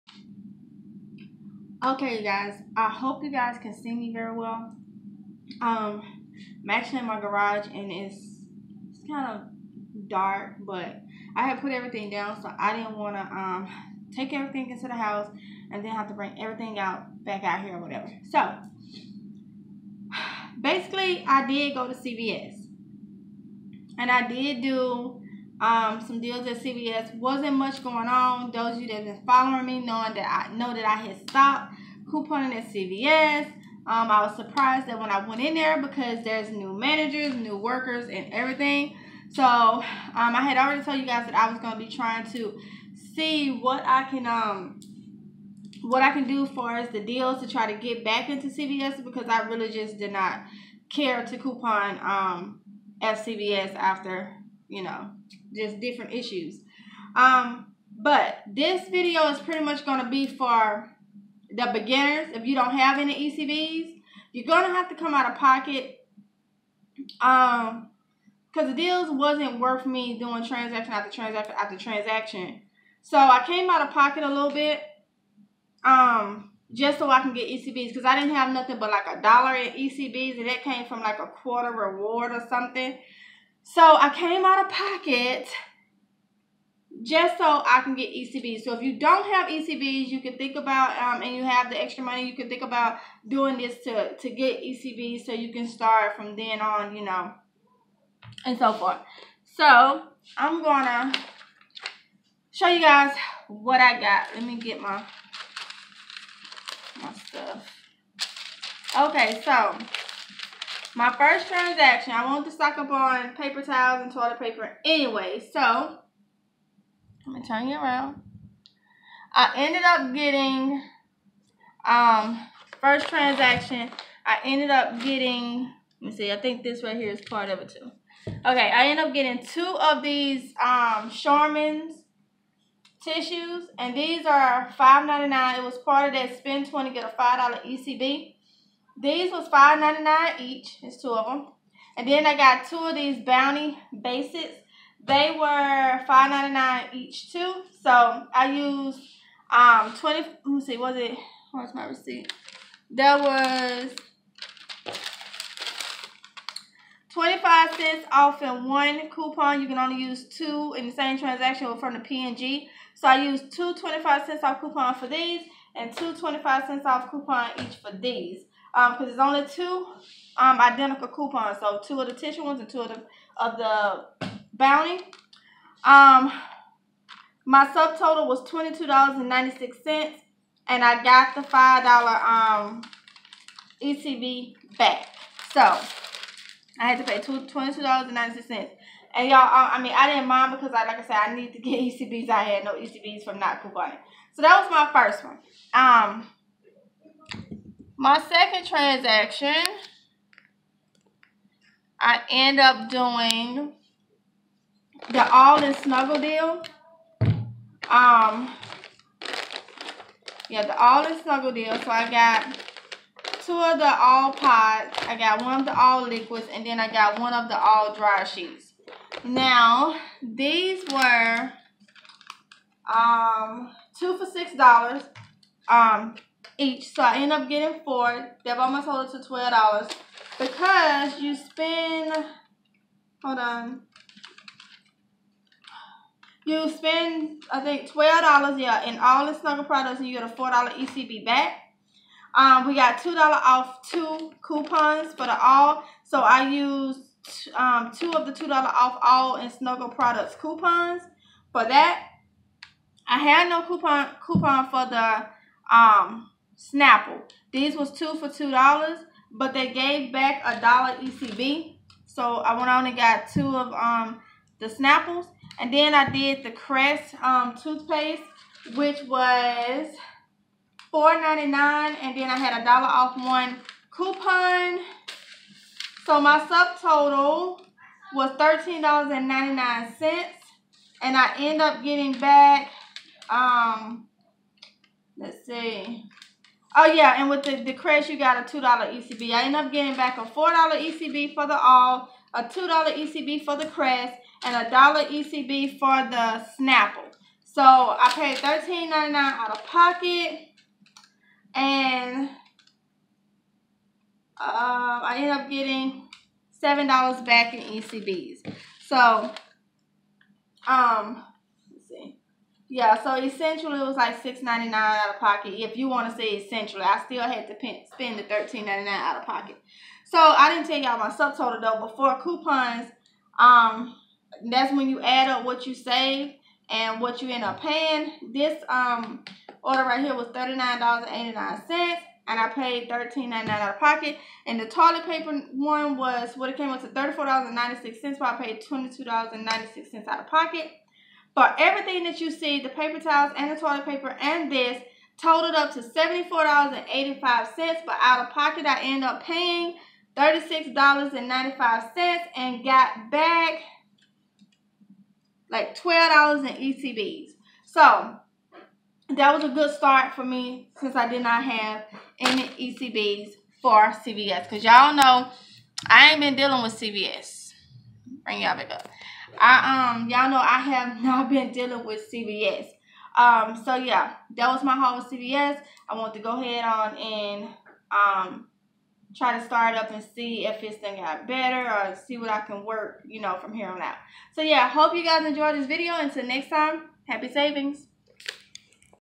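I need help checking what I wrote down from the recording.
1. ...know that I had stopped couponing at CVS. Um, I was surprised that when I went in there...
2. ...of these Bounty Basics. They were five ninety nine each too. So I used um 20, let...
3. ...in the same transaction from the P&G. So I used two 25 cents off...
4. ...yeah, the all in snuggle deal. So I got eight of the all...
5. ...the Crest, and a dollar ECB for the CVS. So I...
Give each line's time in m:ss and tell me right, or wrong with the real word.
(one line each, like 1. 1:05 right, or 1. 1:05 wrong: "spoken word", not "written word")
1. 0:30 right
2. 2:22 right
3. 2:40 right
4. 3:30 wrong: "two", not "eight"
5. 4:53 wrong: "Snapple", not "CVS".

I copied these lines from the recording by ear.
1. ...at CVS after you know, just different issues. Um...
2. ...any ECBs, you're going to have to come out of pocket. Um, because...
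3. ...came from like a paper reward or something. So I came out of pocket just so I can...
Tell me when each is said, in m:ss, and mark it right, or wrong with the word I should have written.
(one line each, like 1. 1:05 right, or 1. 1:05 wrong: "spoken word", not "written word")
1. 0:53 right
2. 1:02 right
3. 1:20 wrong: "quarter", not "paper".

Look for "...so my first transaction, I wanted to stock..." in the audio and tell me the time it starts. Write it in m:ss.
1:49.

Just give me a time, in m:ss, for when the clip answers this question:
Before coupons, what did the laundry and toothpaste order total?
5:30.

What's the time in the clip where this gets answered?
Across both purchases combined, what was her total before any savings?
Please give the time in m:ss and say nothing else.
5:45.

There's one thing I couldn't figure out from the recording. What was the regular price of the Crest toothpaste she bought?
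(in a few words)
$4.99.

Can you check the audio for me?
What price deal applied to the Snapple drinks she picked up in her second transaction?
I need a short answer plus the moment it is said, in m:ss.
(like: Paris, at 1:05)
2 for $2, at 4:17.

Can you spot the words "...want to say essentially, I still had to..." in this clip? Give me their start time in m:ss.
5:15.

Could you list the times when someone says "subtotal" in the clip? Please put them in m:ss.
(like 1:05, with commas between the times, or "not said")
2:57, 4:36, 5:21.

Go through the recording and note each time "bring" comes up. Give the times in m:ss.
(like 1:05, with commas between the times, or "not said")
0:16, 6:08.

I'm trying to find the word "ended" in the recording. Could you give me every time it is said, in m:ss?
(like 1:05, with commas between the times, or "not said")
1:59, 2:04, 2:08.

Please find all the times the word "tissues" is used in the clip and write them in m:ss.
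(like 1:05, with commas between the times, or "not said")
2:13, 2:52.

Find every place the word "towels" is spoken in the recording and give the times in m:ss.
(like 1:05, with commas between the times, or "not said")
1:53, 5:42.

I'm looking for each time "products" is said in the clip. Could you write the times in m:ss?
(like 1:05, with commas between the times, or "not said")
3:59, 4:09.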